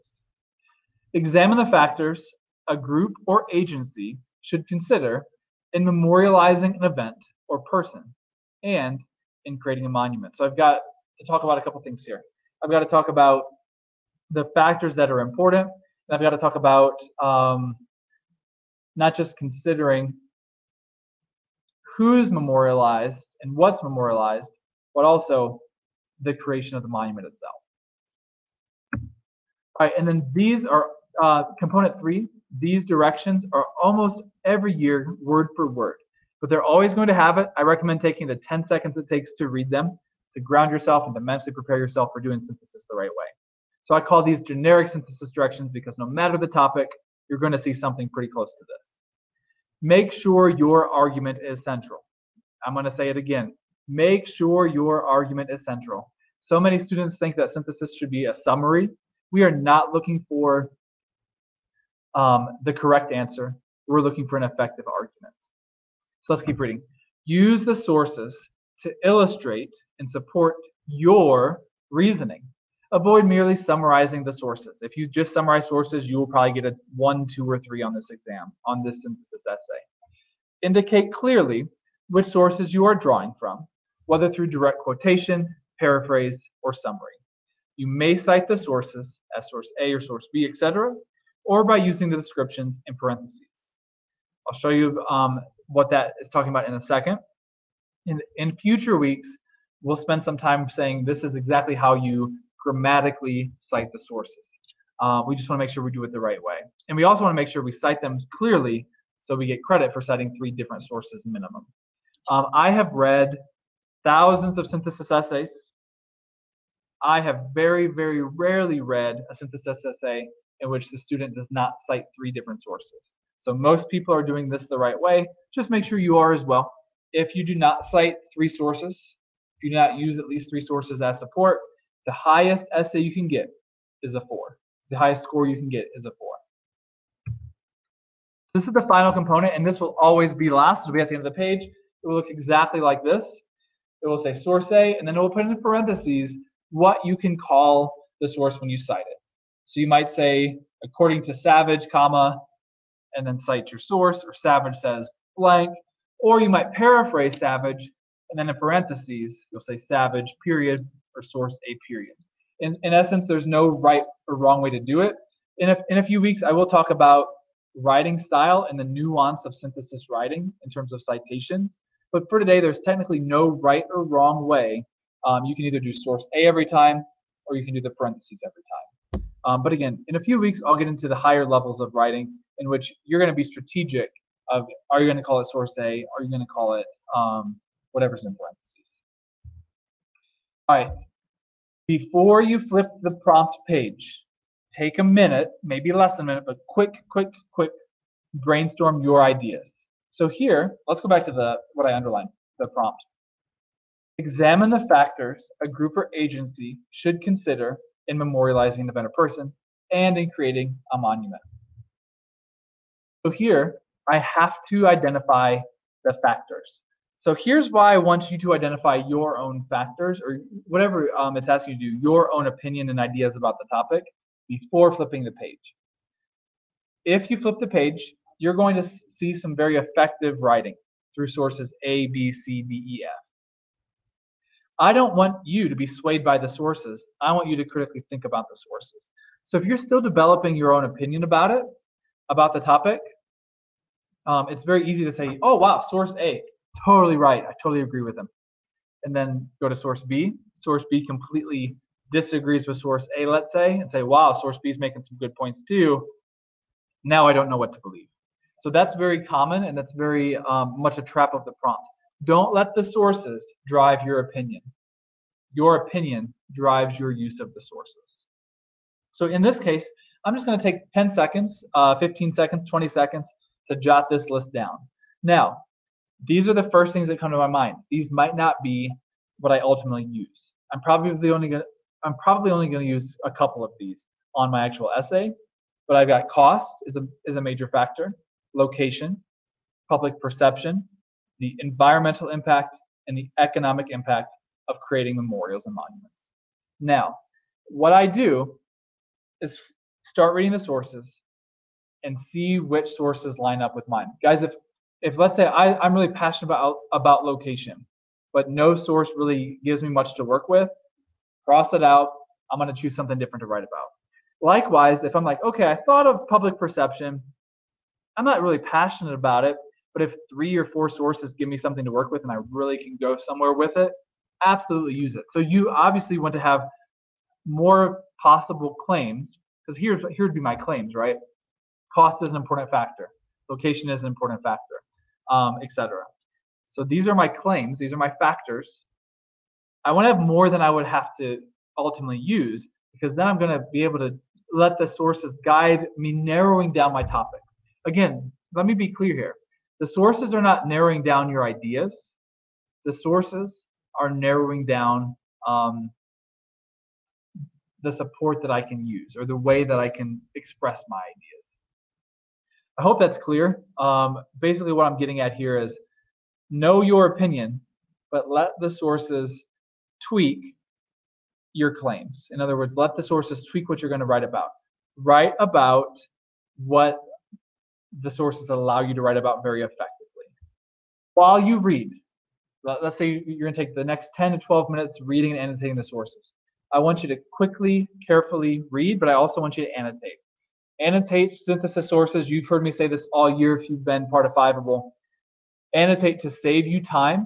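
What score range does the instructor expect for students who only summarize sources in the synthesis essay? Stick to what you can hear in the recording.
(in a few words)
1, 2, or 3.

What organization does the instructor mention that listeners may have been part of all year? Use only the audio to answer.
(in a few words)
Fiveable.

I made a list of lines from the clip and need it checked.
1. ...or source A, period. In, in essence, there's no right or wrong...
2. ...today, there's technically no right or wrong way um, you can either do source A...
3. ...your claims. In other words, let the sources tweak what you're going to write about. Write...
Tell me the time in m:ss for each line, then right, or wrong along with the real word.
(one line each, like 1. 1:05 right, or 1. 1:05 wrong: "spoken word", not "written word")
1. 2:41 right
2. 2:52 right
3. 6:11 right.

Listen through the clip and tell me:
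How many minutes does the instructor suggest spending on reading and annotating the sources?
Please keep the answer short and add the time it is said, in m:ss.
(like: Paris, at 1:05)
10 to 12, at 6:24.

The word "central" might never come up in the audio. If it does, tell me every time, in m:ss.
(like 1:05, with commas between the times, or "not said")
0:51, 0:55.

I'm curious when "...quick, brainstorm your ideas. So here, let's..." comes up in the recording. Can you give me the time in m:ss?
3:17.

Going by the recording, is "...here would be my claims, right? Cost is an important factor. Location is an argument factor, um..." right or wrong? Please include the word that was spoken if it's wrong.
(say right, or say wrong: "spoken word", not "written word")
wrong: "important", not "argument".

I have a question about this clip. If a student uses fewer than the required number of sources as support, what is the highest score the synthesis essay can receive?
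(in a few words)
4.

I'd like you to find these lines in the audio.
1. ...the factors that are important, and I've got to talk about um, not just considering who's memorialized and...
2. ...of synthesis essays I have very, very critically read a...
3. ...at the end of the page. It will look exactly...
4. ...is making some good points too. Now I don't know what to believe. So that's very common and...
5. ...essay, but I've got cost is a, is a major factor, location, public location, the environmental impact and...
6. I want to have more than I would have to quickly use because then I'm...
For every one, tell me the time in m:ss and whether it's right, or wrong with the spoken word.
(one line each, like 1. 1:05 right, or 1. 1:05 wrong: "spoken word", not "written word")
1. 0:14 right
2. 1:54 wrong: "rarely", not "critically"
3. 2:21 right
4. 4:14 right
5. 4:44 wrong: "perception", not "location"
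6. 5:39 wrong: "ultimately", not "quickly".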